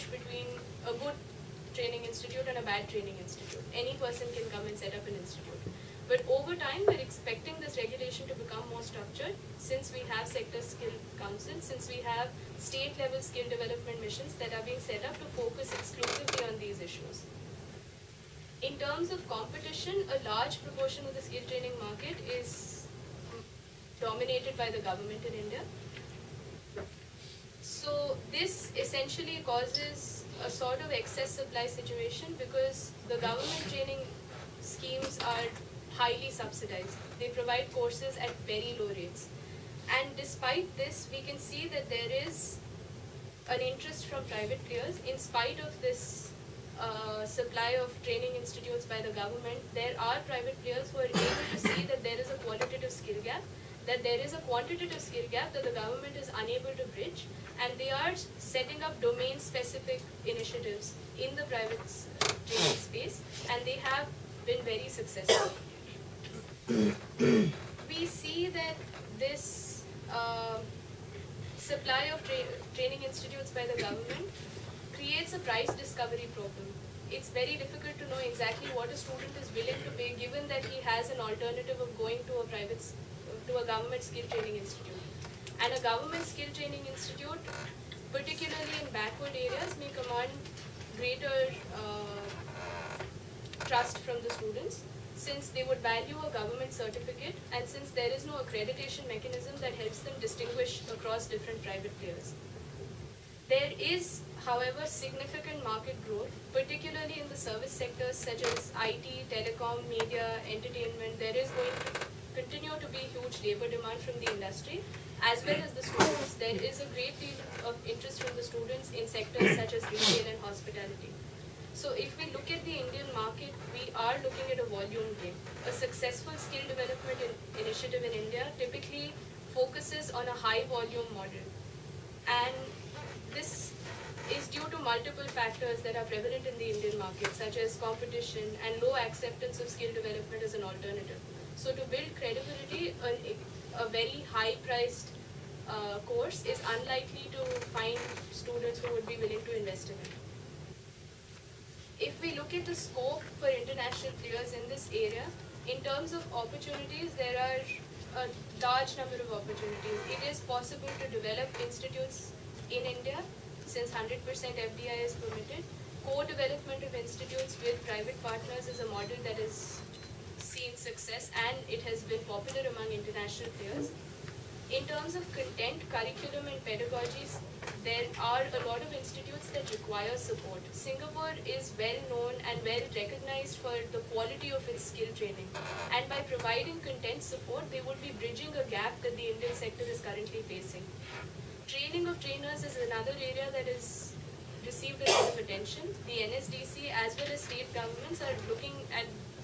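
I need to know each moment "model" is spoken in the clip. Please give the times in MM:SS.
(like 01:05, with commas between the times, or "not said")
02:11, 02:48.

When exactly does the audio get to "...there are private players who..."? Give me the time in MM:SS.
00:49.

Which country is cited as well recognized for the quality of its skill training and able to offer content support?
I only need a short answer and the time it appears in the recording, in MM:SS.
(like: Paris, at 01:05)
Singapore, at 03:00.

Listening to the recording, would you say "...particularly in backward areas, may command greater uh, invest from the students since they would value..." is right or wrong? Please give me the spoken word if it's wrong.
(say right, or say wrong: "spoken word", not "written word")
wrong: "trust", not "invest".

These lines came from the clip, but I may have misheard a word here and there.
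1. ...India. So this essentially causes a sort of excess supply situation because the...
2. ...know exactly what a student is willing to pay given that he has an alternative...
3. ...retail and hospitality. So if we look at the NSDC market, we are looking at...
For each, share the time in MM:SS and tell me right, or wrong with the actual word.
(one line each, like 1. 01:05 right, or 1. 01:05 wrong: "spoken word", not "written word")
1. 00:25 right
2. 01:18 right
3. 01:59 wrong: "Indian", not "NSDC".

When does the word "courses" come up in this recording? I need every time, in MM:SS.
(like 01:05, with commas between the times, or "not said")
00:37, 02:26.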